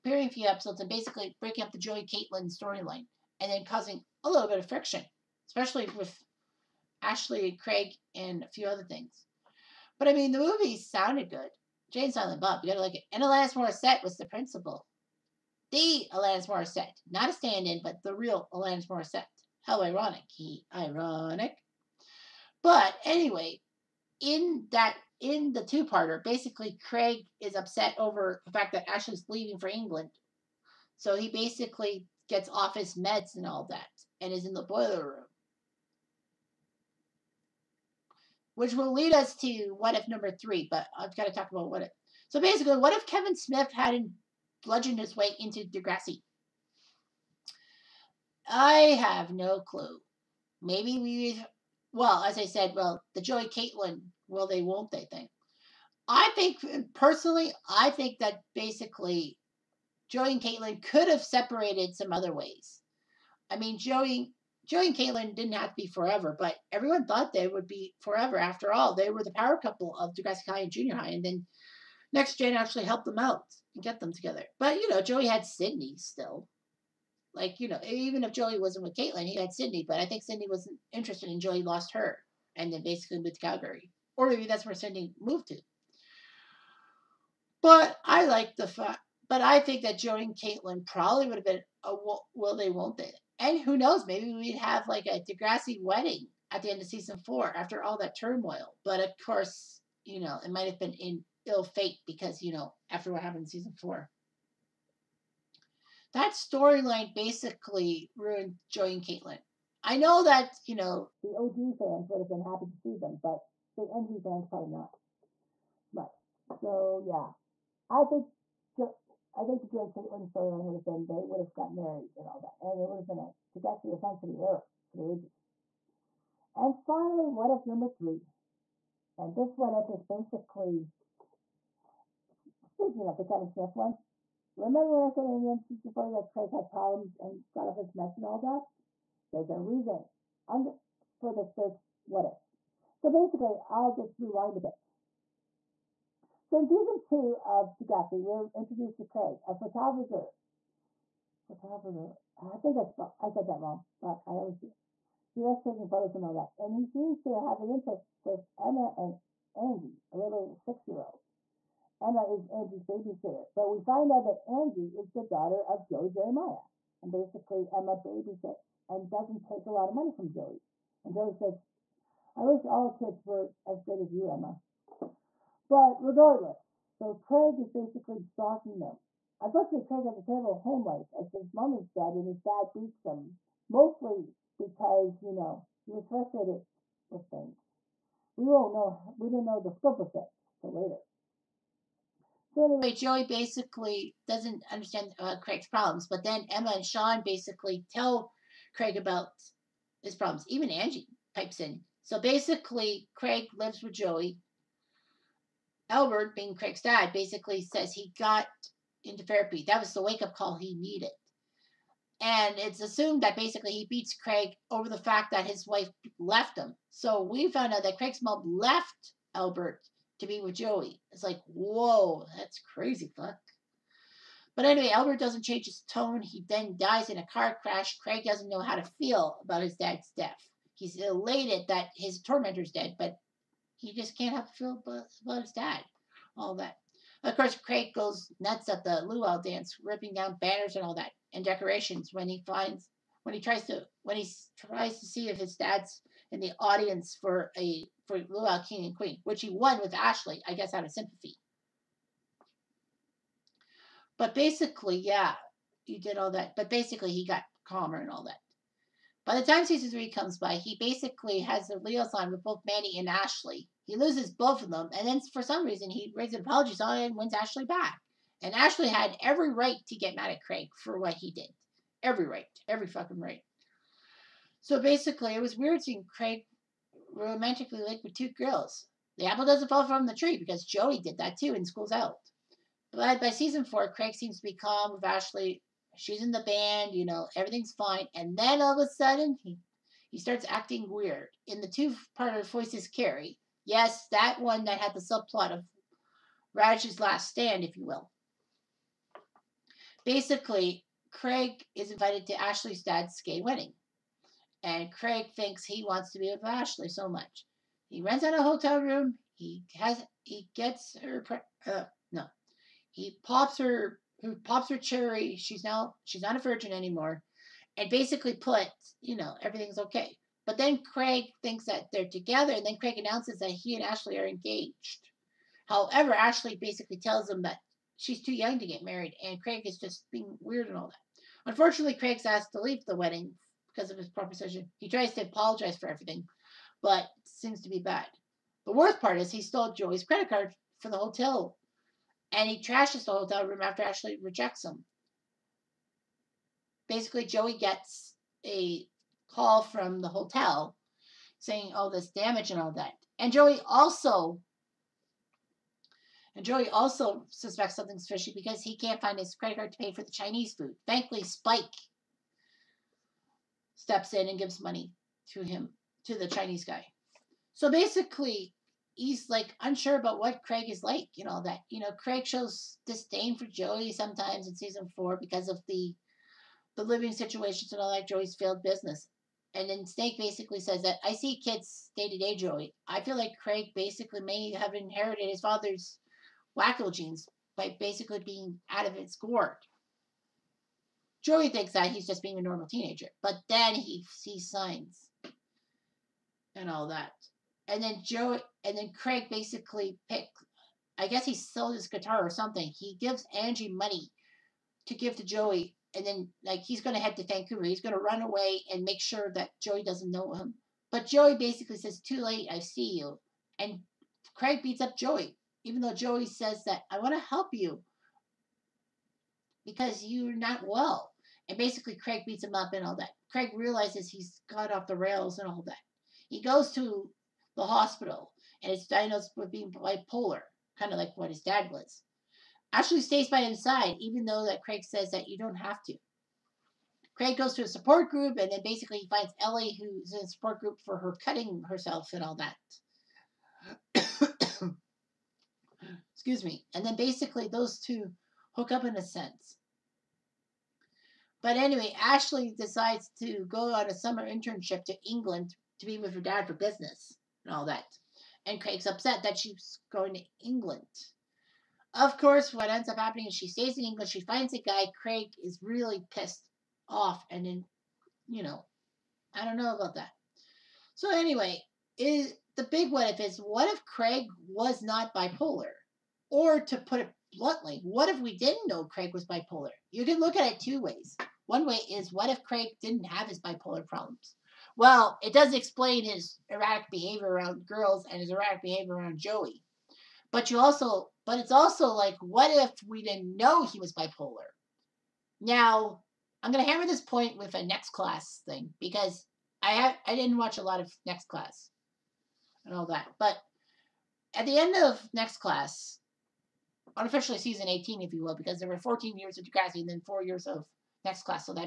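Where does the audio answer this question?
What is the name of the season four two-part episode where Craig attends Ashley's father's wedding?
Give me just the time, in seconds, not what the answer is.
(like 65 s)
292 s.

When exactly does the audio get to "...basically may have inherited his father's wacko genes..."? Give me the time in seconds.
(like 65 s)
383 s.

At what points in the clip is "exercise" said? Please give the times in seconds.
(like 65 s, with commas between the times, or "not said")
not said.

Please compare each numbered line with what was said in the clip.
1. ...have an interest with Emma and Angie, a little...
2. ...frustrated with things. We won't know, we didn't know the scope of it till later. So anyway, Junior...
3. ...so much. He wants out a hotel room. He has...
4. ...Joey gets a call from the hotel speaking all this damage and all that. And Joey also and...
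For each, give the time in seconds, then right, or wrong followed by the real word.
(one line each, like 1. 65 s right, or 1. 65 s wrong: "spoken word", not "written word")
1. 157 s right
2. 186 s wrong: "Joey", not "Junior"
3. 306 s wrong: "rents", not "wants"
4. 347 s wrong: "saying", not "speaking".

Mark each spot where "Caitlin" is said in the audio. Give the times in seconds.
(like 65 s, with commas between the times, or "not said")
2 s, 53 s, 60 s, 64 s, 78 s, 90 s, 109 s, 119 s.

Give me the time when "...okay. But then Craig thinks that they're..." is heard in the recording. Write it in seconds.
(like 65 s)
319 s.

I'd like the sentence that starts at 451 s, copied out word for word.
But anyway, Ashley decides to go on a summer internship to England to be with her dad for business and all that.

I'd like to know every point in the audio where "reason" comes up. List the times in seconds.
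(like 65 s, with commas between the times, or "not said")
139 s, 265 s.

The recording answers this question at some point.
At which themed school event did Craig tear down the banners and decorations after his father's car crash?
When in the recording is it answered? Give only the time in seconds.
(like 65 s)
239 s.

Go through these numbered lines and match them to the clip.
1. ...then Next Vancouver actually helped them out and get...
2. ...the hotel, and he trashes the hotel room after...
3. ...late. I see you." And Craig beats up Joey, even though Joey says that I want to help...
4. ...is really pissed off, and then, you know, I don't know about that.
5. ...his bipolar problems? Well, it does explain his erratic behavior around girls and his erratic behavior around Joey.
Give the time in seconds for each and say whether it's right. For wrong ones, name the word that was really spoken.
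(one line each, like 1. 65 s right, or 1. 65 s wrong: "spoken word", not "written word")
1. 71 s wrong: "Gen", not "Vancouver"
2. 340 s right
3. 412 s right
4. 465 s right
5. 483 s right.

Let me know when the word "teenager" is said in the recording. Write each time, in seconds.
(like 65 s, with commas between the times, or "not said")
392 s.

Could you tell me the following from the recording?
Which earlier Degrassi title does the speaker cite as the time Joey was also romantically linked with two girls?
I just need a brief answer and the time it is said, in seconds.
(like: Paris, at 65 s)
School's Out, at 281 s.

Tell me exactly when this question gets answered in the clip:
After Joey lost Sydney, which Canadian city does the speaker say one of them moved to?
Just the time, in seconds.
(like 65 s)
83 s.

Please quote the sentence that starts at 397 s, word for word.
And then Joey, and then Craig basically pick.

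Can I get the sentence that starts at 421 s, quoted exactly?
And basically, Craig beats him up and all that.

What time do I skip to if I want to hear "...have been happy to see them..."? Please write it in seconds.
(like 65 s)
112 s.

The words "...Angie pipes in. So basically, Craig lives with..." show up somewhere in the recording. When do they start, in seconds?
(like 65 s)
200 s.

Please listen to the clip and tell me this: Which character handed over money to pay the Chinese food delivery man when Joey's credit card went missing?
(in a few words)
Spike.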